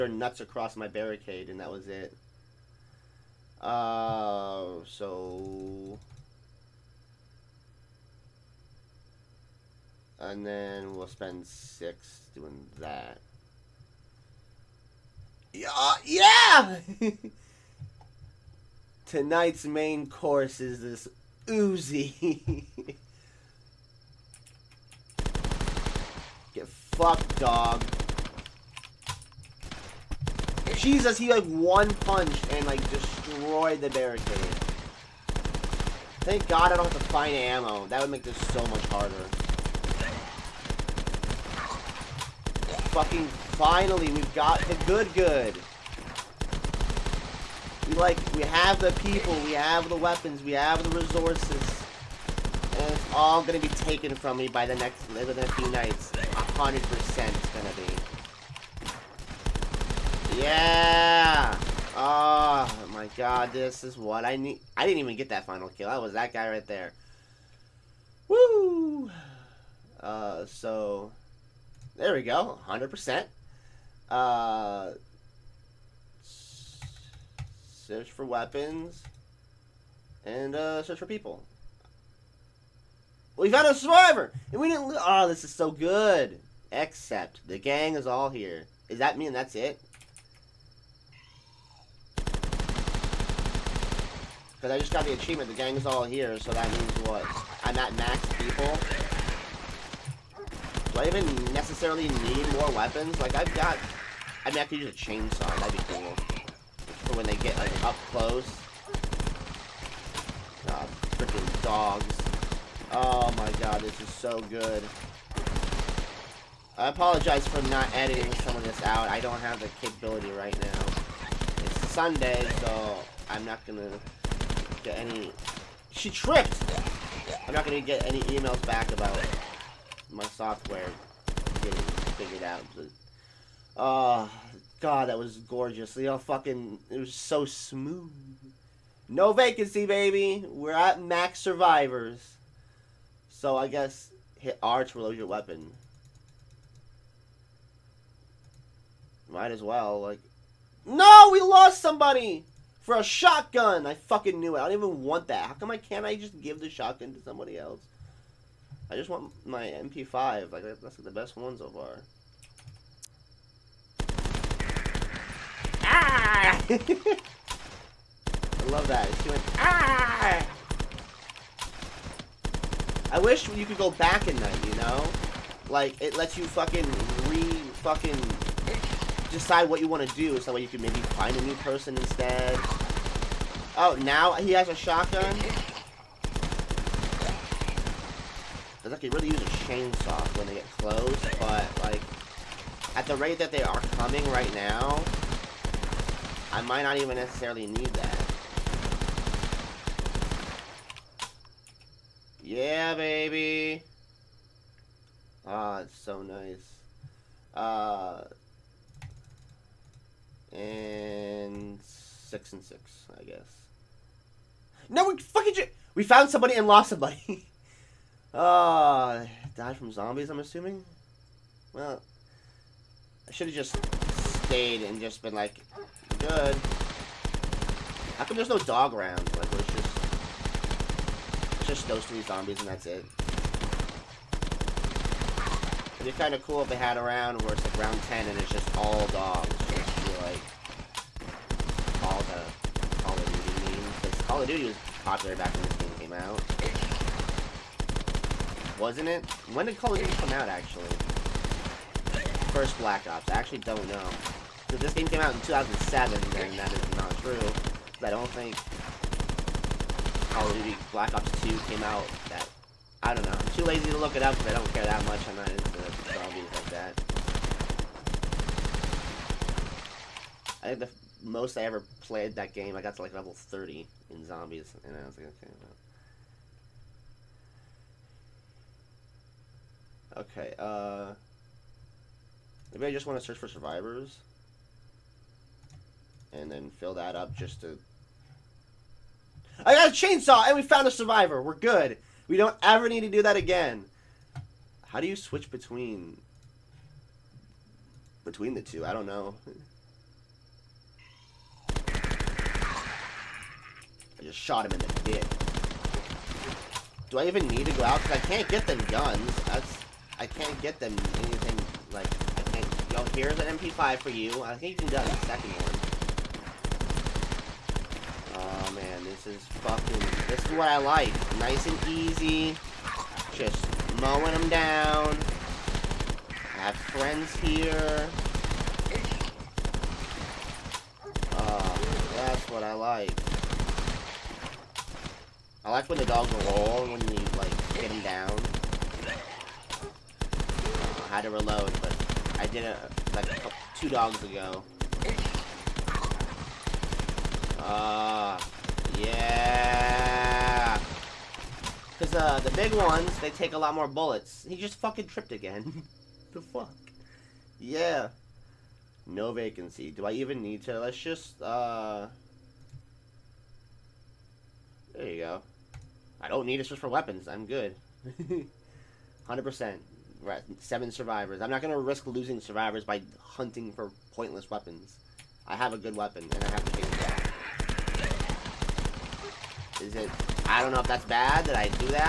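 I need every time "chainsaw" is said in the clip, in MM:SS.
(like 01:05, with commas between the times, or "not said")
01:44, 03:09, 04:49.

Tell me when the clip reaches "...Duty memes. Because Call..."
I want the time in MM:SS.
04:03.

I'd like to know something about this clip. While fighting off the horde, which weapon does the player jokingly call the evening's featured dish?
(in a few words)
Uzi.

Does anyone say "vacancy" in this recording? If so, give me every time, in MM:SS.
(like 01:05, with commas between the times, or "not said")
02:19, 05:59.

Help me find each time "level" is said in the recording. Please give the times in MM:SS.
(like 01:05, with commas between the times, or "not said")
04:33.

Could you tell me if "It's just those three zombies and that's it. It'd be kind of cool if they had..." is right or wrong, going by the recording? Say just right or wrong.
right.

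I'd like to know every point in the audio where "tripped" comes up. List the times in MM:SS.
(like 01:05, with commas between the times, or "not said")
02:06, 05:55.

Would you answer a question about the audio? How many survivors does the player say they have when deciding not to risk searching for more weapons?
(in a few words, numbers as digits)
7.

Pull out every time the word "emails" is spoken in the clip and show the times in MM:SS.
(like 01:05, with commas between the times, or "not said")
02:08.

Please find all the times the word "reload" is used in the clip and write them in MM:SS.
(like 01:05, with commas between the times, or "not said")
02:24, 05:41.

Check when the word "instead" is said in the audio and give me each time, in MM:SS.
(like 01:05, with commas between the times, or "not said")
03:01.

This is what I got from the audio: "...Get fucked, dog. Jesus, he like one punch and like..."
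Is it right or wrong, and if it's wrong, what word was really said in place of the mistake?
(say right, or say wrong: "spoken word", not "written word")
right.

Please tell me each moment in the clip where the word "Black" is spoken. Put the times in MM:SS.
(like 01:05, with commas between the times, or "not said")
04:12, 04:20.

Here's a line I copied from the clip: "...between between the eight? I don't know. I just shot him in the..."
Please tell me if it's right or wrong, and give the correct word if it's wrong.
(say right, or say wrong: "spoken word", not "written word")
wrong: "two", not "eight".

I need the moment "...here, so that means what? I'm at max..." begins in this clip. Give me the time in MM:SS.
01:36.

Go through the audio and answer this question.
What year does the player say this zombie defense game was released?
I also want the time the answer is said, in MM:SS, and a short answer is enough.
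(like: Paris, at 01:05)
2007, at 04:15.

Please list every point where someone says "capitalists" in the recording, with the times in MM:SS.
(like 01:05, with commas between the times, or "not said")
not said.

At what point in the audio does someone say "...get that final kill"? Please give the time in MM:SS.
01:05.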